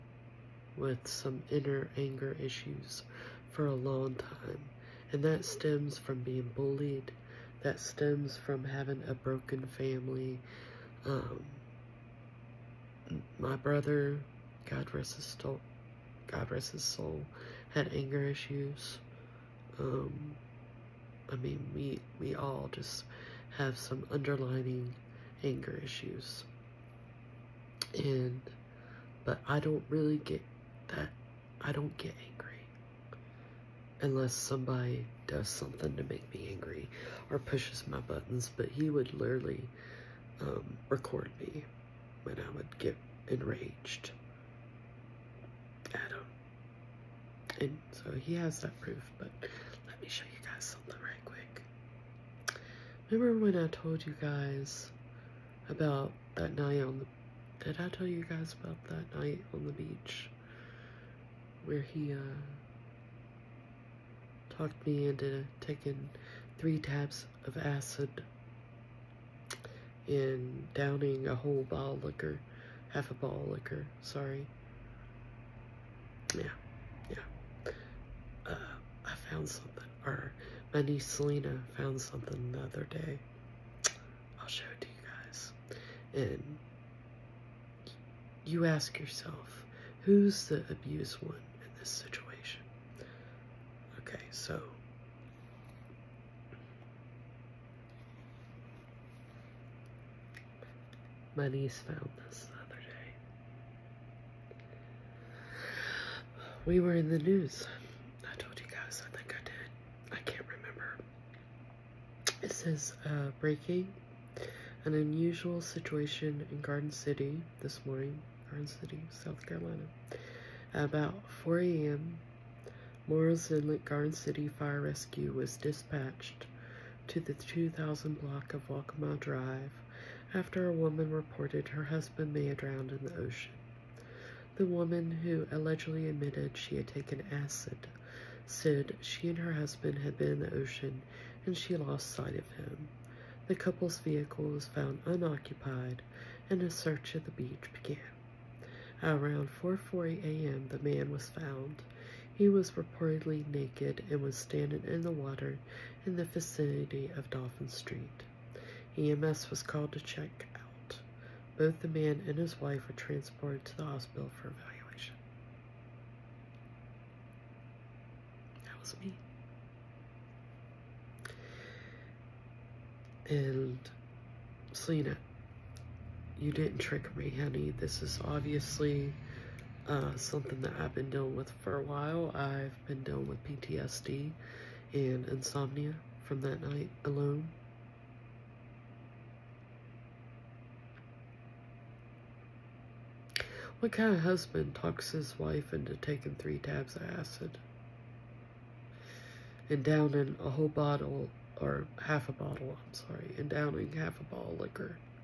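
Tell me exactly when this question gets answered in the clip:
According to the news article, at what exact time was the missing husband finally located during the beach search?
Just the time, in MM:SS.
02:29.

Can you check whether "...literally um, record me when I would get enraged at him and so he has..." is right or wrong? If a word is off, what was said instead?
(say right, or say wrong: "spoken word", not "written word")
right.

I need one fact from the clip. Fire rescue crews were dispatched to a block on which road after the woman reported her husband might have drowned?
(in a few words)
Waccamaw Drive.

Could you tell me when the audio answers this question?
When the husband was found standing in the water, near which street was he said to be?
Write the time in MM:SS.
02:37.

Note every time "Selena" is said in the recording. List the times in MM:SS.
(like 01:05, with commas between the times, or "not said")
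01:21, 02:54.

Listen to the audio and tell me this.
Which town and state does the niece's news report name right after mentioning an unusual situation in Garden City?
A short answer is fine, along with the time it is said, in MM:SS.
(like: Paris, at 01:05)
Pine City, South Carolina, at 01:58.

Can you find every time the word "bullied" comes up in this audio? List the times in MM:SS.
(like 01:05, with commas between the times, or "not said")
00:06.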